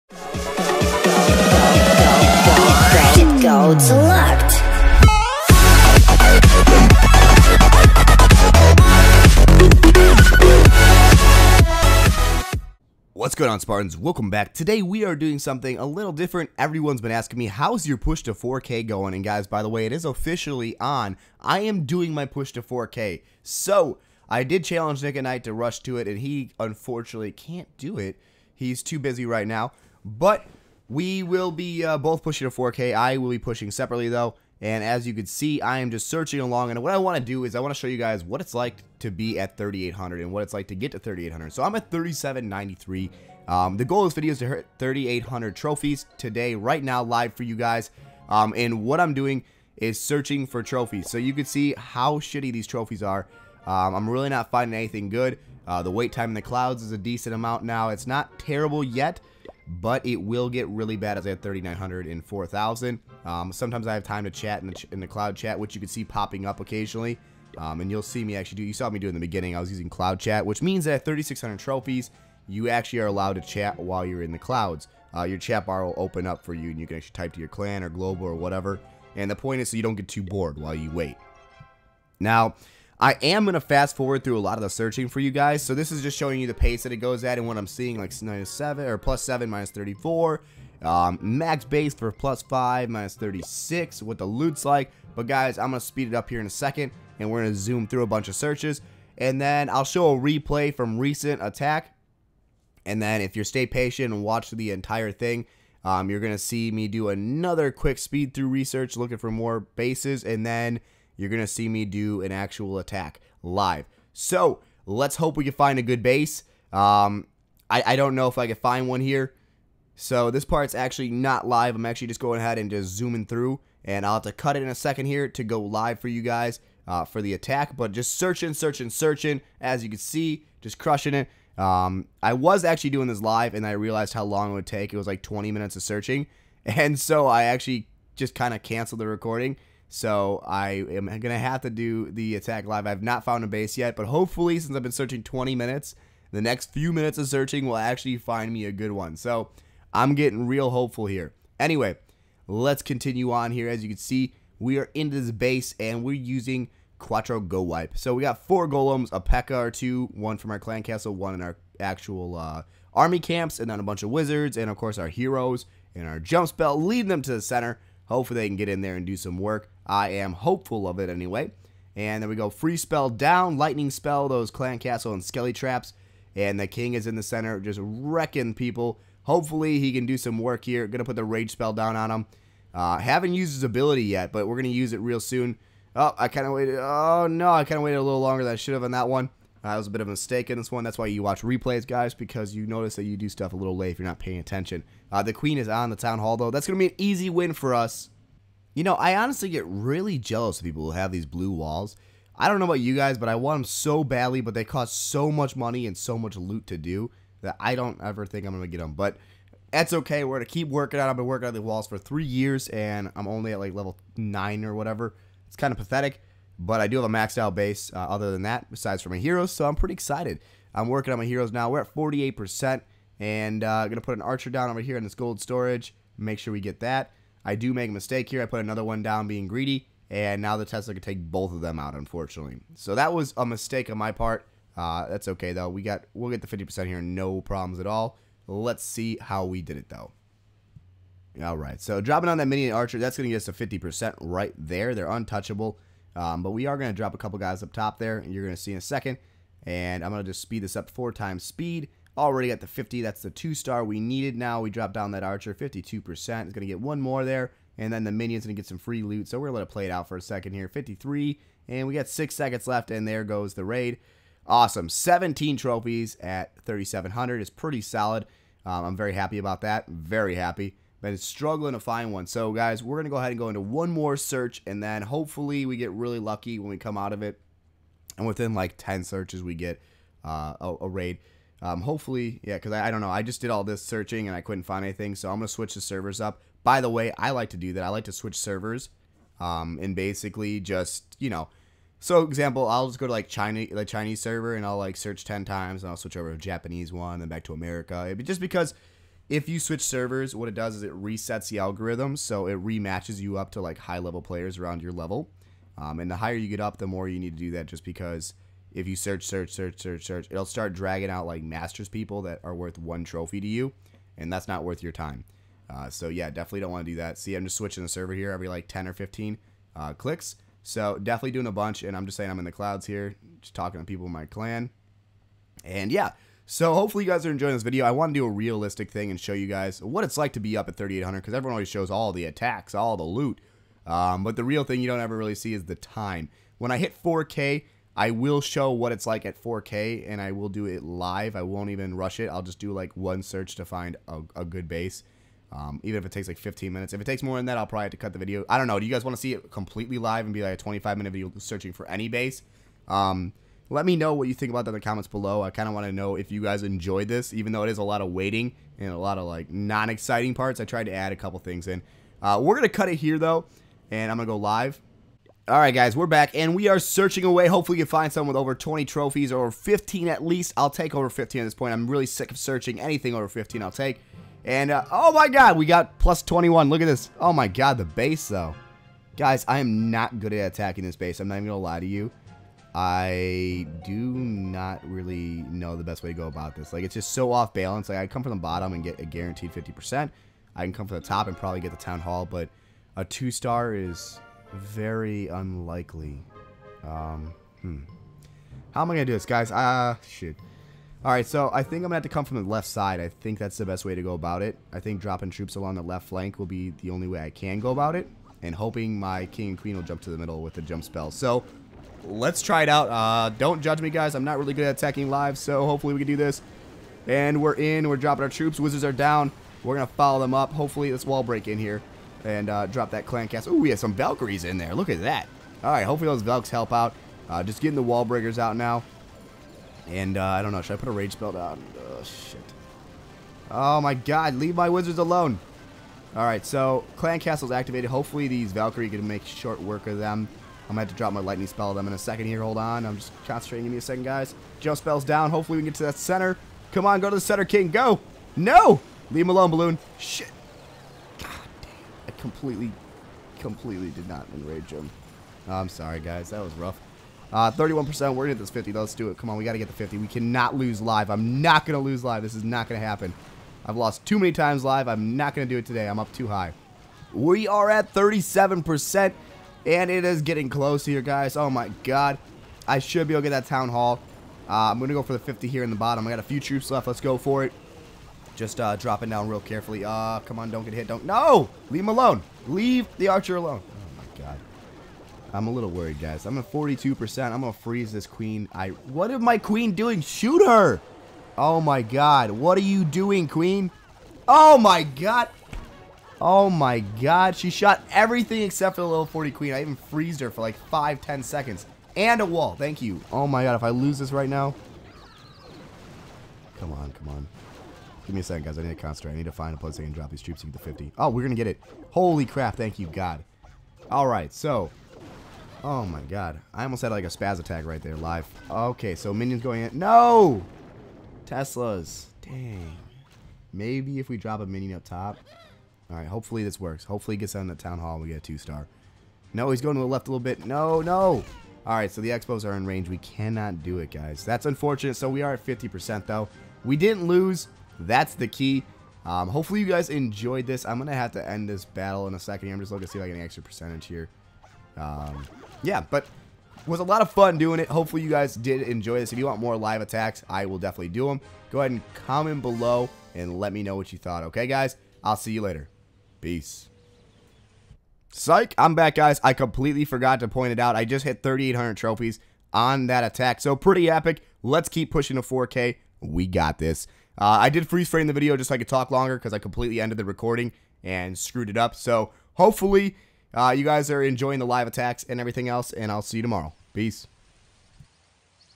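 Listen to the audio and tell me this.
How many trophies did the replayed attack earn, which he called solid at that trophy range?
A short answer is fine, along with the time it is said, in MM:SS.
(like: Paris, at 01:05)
17, at 04:24.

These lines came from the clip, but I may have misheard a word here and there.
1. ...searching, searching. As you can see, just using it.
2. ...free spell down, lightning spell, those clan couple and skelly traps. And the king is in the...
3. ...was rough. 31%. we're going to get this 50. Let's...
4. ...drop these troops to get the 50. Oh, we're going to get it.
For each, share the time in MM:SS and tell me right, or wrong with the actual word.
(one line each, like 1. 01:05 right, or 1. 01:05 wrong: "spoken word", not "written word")
1. 02:08 wrong: "crushing", not "using"
2. 02:52 wrong: "castle", not "couple"
3. 07:36 right
4. 08:29 right.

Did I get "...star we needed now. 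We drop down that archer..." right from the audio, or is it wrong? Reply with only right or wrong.
right.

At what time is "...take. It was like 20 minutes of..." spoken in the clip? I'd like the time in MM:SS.
02:14.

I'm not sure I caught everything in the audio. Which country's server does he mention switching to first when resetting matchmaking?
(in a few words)
China.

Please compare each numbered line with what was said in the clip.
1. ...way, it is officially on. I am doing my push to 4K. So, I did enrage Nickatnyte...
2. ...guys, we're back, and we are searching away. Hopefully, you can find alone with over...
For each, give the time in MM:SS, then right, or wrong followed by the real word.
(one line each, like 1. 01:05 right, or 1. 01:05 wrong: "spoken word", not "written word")
1. 00:19 wrong: "challenge", not "enrage"
2. 06:05 wrong: "someone", not "alone".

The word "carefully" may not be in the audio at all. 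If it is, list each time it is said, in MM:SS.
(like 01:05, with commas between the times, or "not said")
07:59.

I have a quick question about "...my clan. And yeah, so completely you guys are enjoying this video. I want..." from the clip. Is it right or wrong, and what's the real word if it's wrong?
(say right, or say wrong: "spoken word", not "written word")
wrong: "hopefully", not "completely".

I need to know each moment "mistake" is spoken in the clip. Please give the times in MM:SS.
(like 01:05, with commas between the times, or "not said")
03:10, 03:47, 03:53.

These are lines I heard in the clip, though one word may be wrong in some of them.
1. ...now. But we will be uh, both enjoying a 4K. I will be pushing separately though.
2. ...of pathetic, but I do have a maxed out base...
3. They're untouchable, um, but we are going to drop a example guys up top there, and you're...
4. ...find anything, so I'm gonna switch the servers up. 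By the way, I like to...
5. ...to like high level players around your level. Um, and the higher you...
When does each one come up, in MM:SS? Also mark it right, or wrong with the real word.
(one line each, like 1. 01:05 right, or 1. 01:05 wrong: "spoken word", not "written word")
1. 00:29 wrong: "pushing", not "enjoying"
2. 03:35 right
3. 04:04 wrong: "couple", not "example"
4. 04:44 right
5. 05:03 right.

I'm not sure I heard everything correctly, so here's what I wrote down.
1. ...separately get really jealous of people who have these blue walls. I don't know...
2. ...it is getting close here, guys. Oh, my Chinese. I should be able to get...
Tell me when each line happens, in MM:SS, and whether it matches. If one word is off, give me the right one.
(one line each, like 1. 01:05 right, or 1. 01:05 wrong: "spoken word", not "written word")
1. 03:19 wrong: "honestly", not "separately"
2. 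07:49 wrong: "God", not "Chinese".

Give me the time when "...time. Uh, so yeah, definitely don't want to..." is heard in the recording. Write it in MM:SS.
05:14.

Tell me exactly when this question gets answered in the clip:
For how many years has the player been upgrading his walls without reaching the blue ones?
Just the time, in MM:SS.
03:31.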